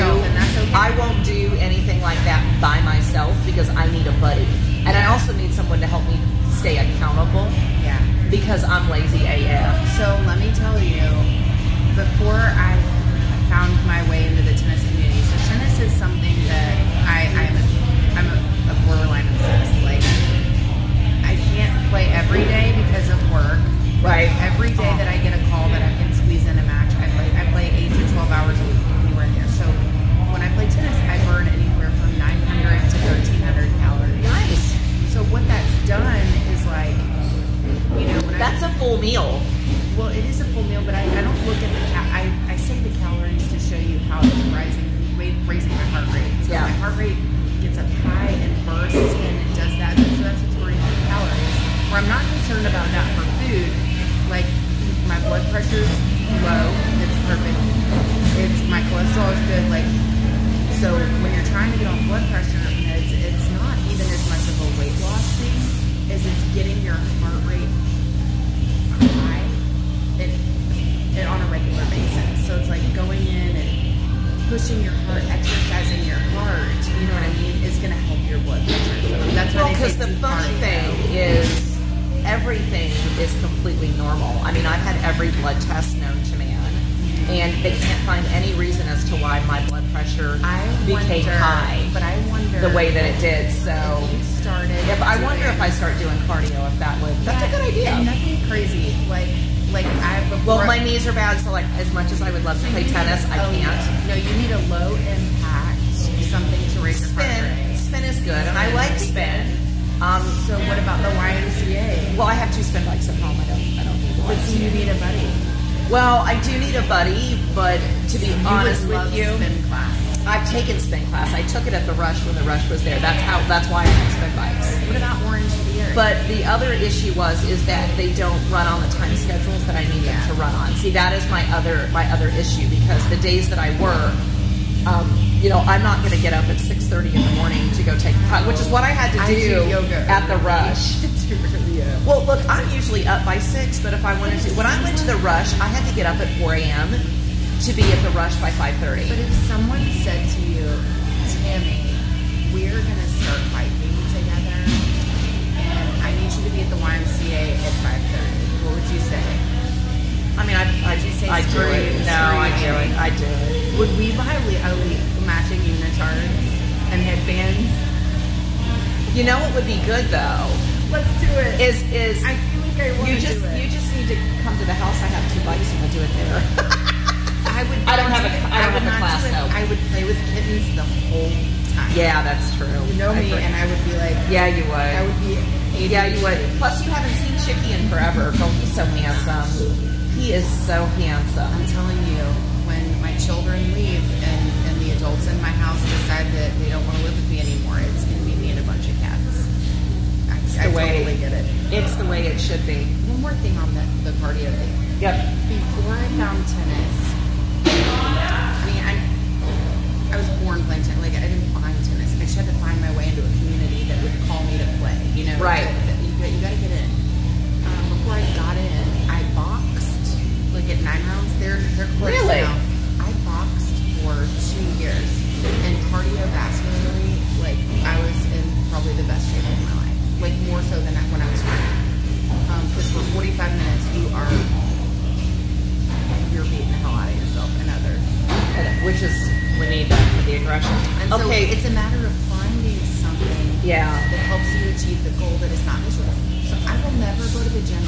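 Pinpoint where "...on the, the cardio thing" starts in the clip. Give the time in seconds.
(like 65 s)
203 s.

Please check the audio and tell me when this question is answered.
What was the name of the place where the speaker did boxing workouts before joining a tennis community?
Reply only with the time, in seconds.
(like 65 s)
220 s.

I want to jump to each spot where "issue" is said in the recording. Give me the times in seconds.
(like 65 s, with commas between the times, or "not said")
126 s, 132 s.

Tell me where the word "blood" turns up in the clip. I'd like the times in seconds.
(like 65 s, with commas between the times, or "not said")
62 s, 78 s, 85 s, 89 s.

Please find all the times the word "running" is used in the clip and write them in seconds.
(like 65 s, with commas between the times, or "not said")
231 s.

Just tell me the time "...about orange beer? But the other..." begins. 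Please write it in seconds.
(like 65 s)
124 s.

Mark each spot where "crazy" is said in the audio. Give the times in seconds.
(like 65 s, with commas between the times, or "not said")
98 s, 221 s.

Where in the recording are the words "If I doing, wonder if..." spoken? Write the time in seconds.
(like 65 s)
94 s.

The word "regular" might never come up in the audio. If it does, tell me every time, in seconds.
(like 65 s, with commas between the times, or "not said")
71 s.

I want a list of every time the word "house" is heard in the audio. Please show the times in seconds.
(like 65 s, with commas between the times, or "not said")
174 s, 195 s.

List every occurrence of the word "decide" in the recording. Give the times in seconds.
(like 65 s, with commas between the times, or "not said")
195 s.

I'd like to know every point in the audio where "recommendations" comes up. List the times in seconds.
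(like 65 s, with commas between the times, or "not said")
not said.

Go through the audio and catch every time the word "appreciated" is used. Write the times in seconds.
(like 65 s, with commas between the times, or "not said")
not said.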